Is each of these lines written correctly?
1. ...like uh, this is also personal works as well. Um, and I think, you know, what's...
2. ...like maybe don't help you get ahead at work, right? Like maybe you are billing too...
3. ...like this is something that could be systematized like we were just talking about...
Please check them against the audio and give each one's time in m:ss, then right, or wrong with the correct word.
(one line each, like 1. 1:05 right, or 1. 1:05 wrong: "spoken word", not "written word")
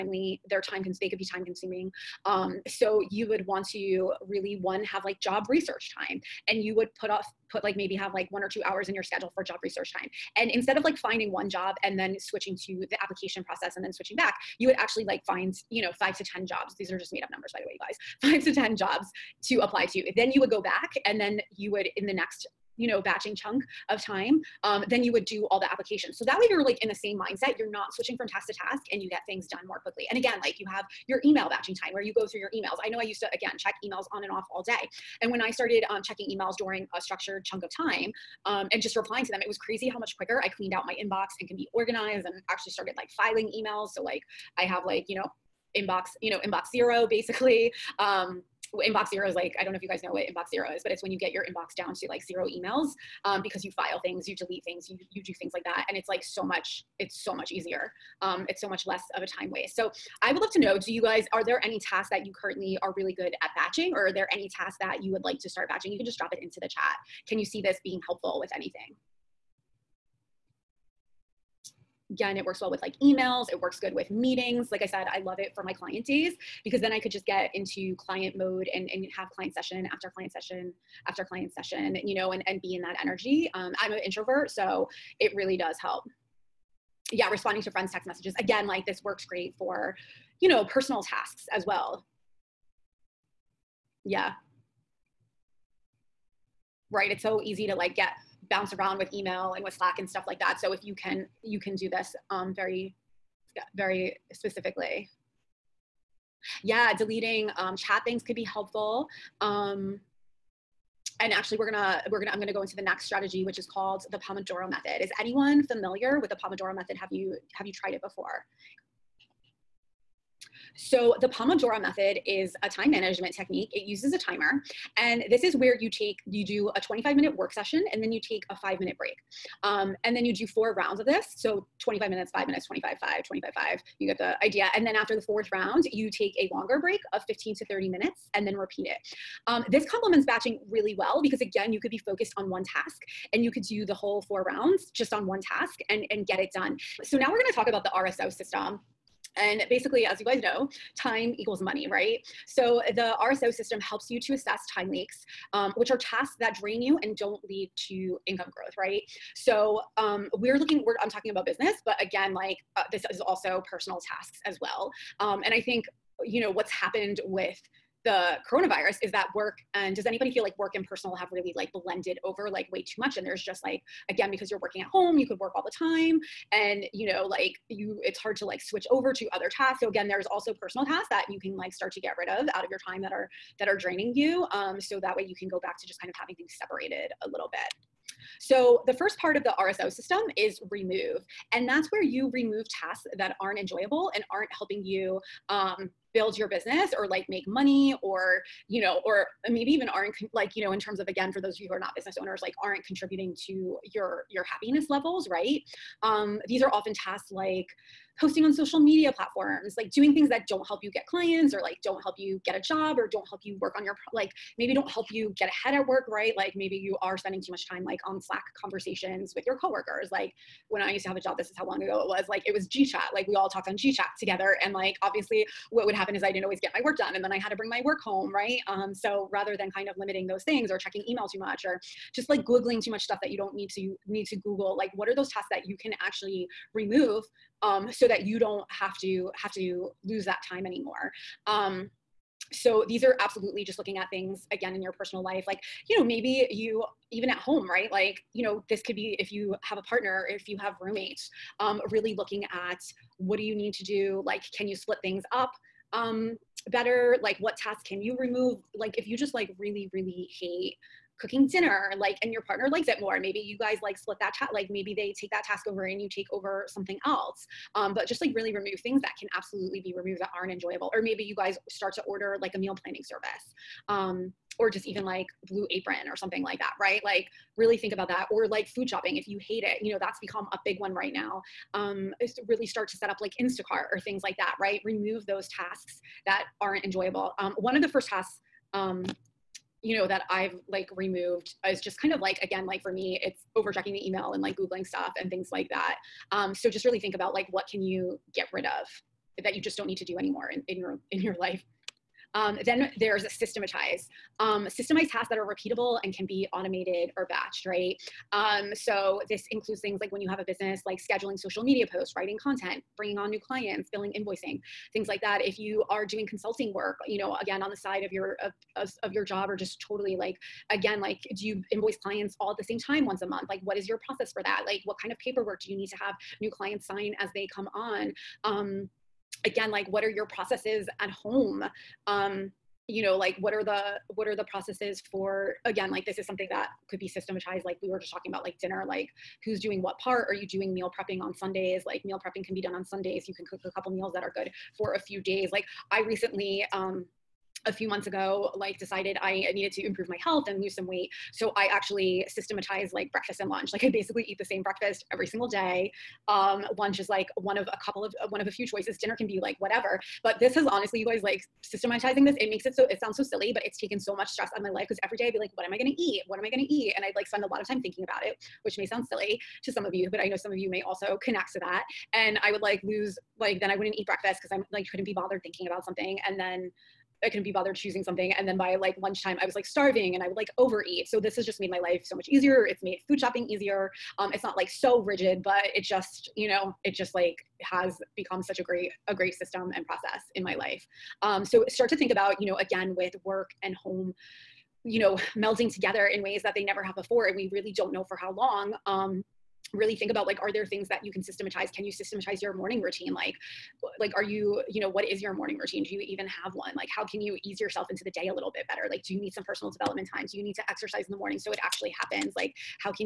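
1. 2:42 wrong: "tasks", not "works"
2. 3:34 wrong: "spending", not "billing"
3. 5:35 right.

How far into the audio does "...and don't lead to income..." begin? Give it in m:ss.
2:37.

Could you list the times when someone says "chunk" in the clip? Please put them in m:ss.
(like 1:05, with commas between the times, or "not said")
0:23, 0:37.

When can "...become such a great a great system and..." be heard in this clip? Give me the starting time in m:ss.
6:28.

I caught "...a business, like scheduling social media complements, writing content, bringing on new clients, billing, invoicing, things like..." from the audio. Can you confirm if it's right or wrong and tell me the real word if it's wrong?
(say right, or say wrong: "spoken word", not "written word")
wrong: "posts", not "complements".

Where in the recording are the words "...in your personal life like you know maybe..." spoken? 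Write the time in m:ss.
4:04.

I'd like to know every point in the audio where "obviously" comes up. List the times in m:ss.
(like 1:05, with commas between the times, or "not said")
3:45.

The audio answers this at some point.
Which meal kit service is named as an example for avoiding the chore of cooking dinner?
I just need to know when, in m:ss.
4:35.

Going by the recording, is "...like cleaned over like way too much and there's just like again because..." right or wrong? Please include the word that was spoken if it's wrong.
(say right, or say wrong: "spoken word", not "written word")
wrong: "blended", not "cleaned".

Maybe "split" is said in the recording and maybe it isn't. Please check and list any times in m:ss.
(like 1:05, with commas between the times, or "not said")
4:14, 4:23.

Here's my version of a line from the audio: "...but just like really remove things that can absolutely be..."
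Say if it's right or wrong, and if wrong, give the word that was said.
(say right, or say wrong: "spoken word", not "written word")
right.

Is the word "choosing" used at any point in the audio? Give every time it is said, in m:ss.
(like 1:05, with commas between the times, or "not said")
6:17.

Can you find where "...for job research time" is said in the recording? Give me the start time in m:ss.
0:09.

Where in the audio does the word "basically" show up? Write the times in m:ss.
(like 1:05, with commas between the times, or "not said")
0:47, 2:29, 5:53.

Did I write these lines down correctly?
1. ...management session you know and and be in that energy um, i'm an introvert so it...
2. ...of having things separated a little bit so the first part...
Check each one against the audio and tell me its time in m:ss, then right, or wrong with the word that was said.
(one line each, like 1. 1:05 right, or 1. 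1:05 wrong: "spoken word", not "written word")
1. 1:21 wrong: "client", not "management"
2. 3:06 right.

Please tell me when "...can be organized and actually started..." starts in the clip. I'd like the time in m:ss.
0:41.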